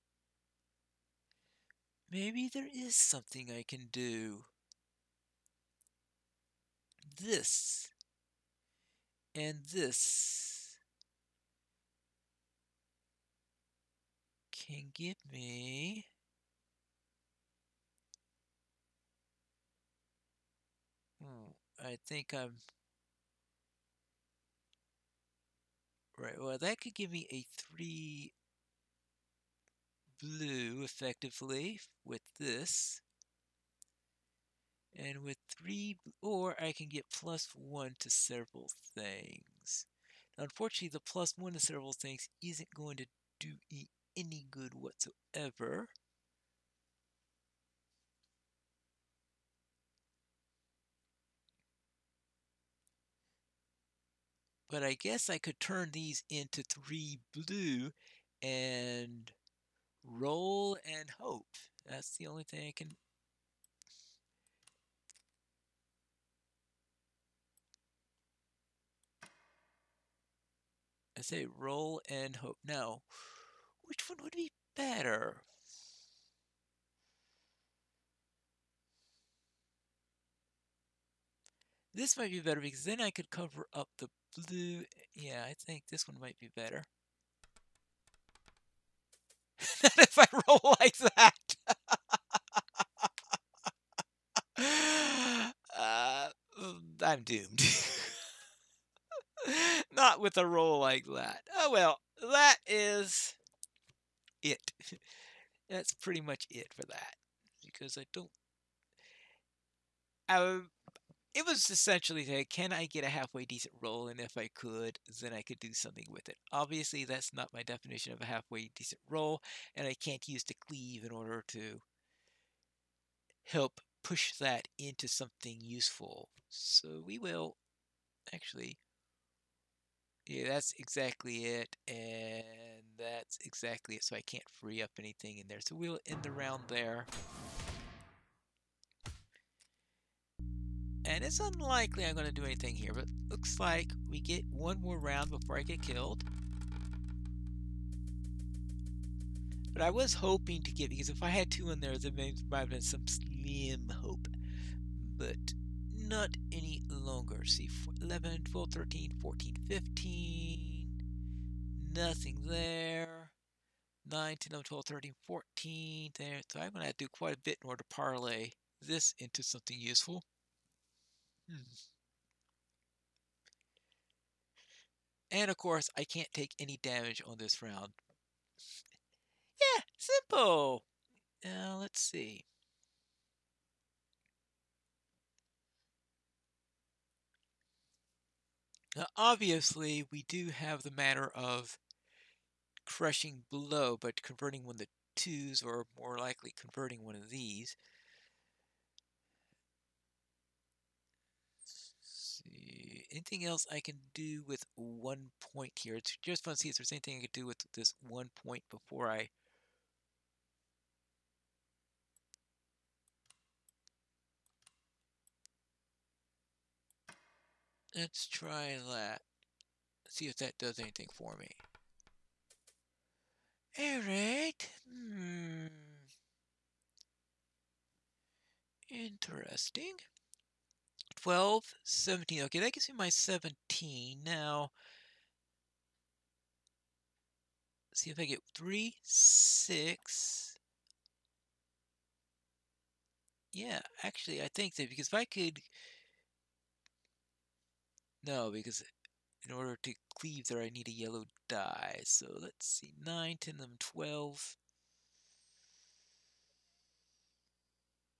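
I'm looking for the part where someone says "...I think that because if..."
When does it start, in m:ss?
4:04.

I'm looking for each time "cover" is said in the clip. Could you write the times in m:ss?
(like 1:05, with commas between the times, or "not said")
1:23.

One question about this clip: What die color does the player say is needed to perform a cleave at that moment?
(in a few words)
yellow.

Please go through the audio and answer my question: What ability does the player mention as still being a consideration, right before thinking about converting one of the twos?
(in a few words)
crushing blow.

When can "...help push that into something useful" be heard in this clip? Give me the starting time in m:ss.
2:03.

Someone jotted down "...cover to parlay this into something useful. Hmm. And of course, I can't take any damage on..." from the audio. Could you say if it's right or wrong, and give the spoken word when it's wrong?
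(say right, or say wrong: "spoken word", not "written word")
wrong: "order", not "cover".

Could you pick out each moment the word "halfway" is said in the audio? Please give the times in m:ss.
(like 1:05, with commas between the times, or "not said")
1:53, 1:58.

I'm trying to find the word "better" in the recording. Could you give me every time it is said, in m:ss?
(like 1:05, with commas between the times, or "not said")
1:14, 1:22, 1:26.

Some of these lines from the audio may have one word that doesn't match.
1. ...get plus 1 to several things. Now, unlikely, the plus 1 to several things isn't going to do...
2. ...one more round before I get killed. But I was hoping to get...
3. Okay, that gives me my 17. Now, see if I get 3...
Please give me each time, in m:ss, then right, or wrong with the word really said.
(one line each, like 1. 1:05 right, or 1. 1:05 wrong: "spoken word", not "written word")
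1. 0:36 wrong: "unfortunately", not "unlikely"
2. 2:24 right
3. 3:52 right.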